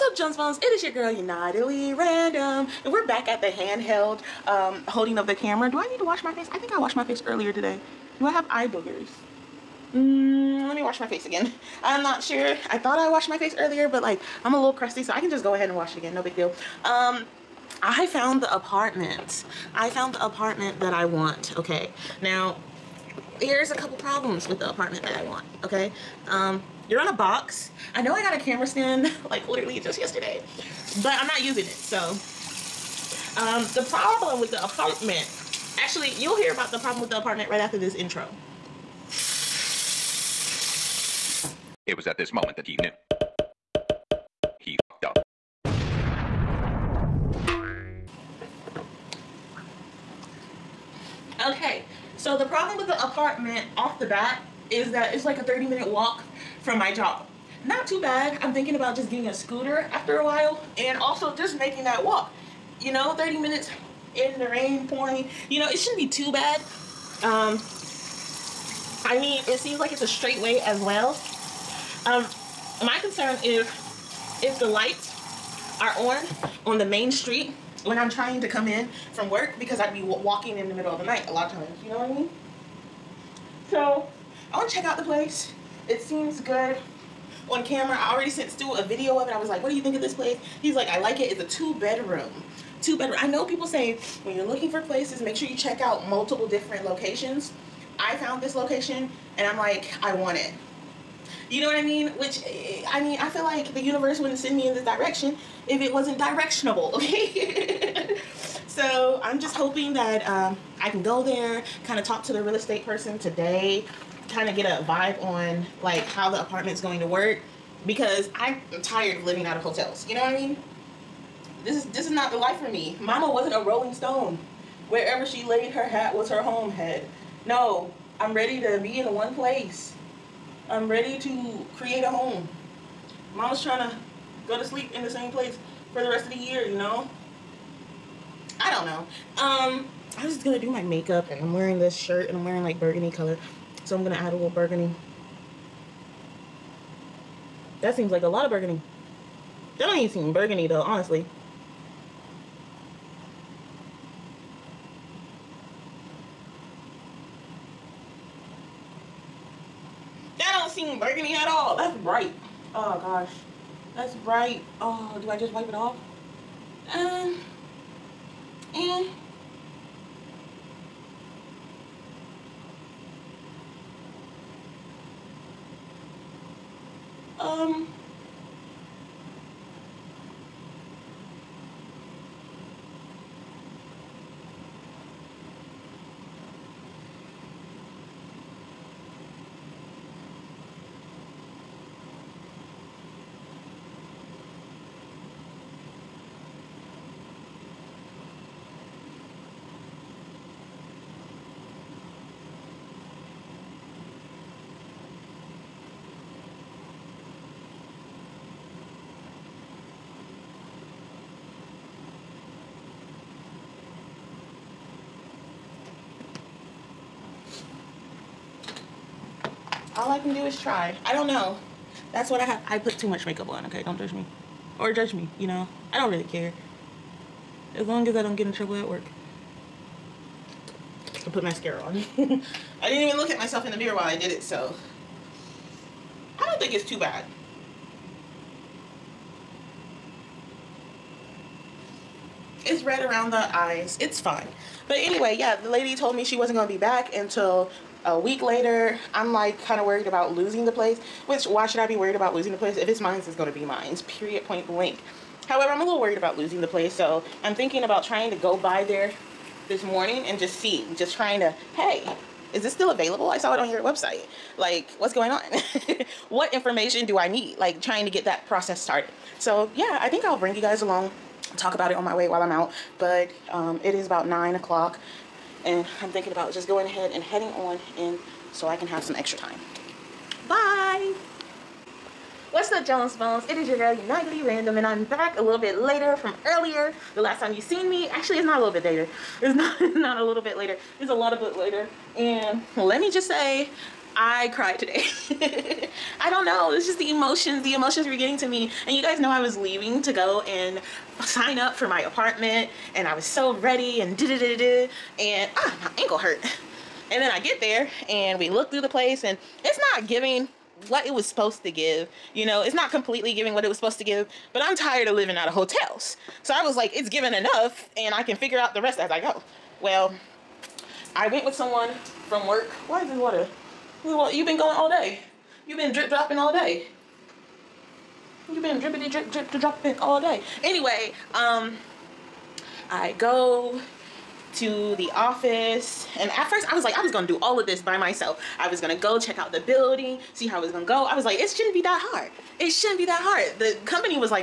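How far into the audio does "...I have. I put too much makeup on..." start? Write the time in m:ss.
3:42.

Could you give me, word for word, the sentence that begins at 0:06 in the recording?
I think I washed my face earlier today.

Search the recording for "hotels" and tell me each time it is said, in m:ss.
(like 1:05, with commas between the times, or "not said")
1:59, 5:15.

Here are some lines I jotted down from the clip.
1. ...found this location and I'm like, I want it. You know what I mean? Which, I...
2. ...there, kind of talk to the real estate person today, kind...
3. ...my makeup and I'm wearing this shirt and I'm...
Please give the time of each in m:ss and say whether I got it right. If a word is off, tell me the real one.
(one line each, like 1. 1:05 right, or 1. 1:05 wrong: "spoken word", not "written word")
1. 1:38 right
2. 1:51 right
3. 2:20 right.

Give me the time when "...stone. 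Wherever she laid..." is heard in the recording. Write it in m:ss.
2:03.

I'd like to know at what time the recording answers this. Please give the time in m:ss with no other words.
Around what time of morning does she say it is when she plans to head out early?
4:34.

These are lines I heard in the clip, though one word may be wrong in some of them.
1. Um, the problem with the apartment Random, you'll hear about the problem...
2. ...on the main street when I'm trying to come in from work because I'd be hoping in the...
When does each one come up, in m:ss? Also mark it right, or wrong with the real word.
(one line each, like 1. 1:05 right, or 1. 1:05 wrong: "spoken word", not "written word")
1. 0:33 wrong: "Actually", not "Random"
2. 1:16 wrong: "walking", not "hoping".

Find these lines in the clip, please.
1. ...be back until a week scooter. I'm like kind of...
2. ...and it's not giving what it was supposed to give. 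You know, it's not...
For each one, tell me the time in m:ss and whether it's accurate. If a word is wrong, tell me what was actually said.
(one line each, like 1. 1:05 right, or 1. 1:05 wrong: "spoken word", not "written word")
1. 4:06 wrong: "later", not "scooter"
2. 5:09 right.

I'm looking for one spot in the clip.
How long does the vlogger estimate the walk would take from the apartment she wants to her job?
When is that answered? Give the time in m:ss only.
0:55.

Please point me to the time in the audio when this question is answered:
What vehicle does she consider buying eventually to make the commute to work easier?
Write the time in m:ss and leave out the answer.
0:59.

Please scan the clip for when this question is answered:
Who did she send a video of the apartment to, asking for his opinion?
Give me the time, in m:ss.
1:28.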